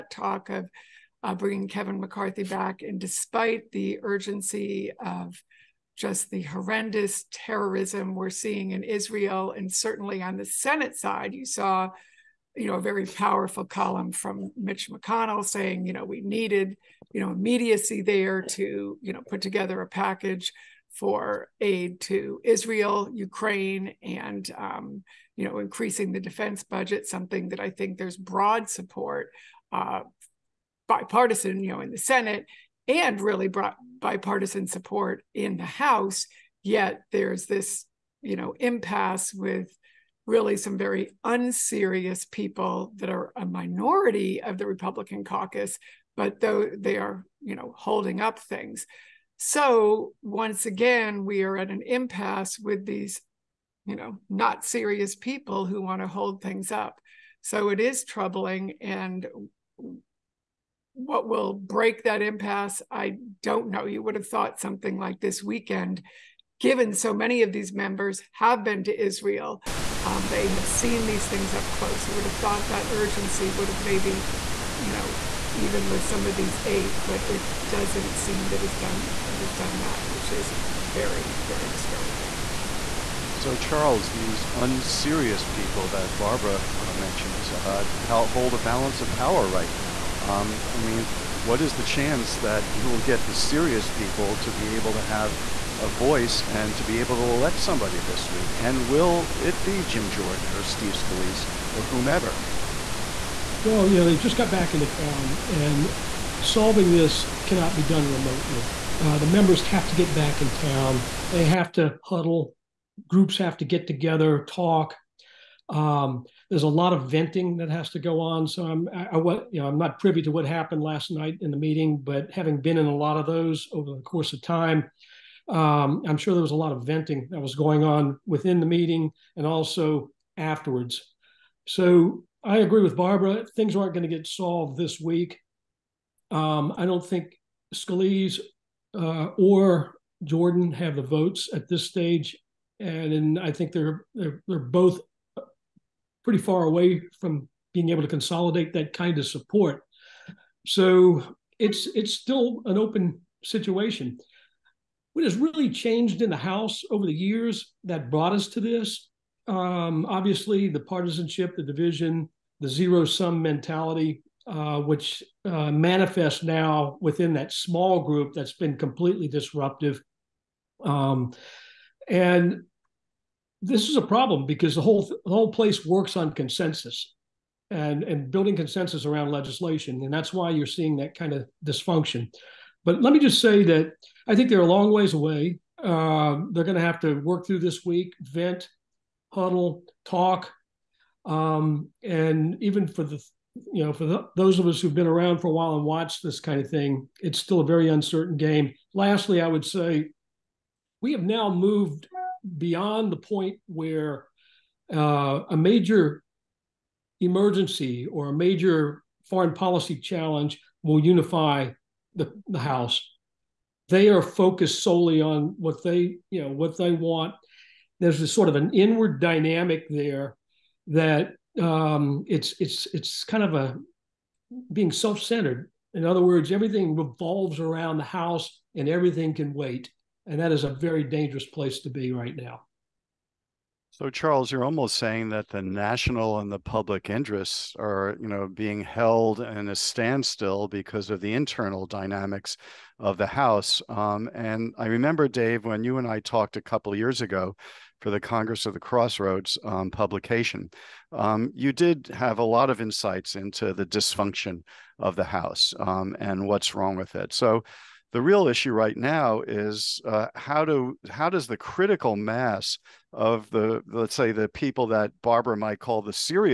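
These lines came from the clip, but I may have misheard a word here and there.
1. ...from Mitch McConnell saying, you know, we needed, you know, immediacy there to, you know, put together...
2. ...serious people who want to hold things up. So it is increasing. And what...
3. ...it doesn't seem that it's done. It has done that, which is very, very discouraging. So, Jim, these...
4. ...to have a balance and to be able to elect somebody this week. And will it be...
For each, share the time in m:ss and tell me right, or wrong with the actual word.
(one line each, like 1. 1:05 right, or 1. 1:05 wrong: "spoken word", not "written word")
1. 0:14 right
2. 0:54 wrong: "troubling", not "increasing"
3. 1:17 wrong: "Charles", not "Jim"
4. 1:34 wrong: "voice", not "balance".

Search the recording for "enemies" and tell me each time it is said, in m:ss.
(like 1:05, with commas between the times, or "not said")
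not said.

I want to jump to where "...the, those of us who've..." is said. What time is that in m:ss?
3:14.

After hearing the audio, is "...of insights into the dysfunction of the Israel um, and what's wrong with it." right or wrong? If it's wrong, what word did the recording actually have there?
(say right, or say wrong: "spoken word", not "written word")
wrong: "House", not "Israel".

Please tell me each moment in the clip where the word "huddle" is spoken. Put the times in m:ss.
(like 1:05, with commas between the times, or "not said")
1:52, 3:09.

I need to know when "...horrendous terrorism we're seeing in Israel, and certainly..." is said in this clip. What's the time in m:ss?
0:06.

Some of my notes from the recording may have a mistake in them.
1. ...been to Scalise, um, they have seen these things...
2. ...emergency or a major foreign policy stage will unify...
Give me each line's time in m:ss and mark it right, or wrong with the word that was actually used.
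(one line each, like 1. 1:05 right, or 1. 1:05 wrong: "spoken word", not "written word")
1. 1:08 wrong: "Israel", not "Scalise"
2. 3:27 wrong: "challenge", not "stage".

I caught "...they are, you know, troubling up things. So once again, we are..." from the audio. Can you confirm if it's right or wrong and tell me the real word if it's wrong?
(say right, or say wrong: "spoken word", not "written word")
wrong: "holding", not "troubling".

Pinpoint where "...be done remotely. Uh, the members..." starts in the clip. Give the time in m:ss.
1:47.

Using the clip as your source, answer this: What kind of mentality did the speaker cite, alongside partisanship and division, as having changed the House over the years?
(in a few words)
zero sum.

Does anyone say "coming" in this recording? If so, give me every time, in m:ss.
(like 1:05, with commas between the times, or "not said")
not said.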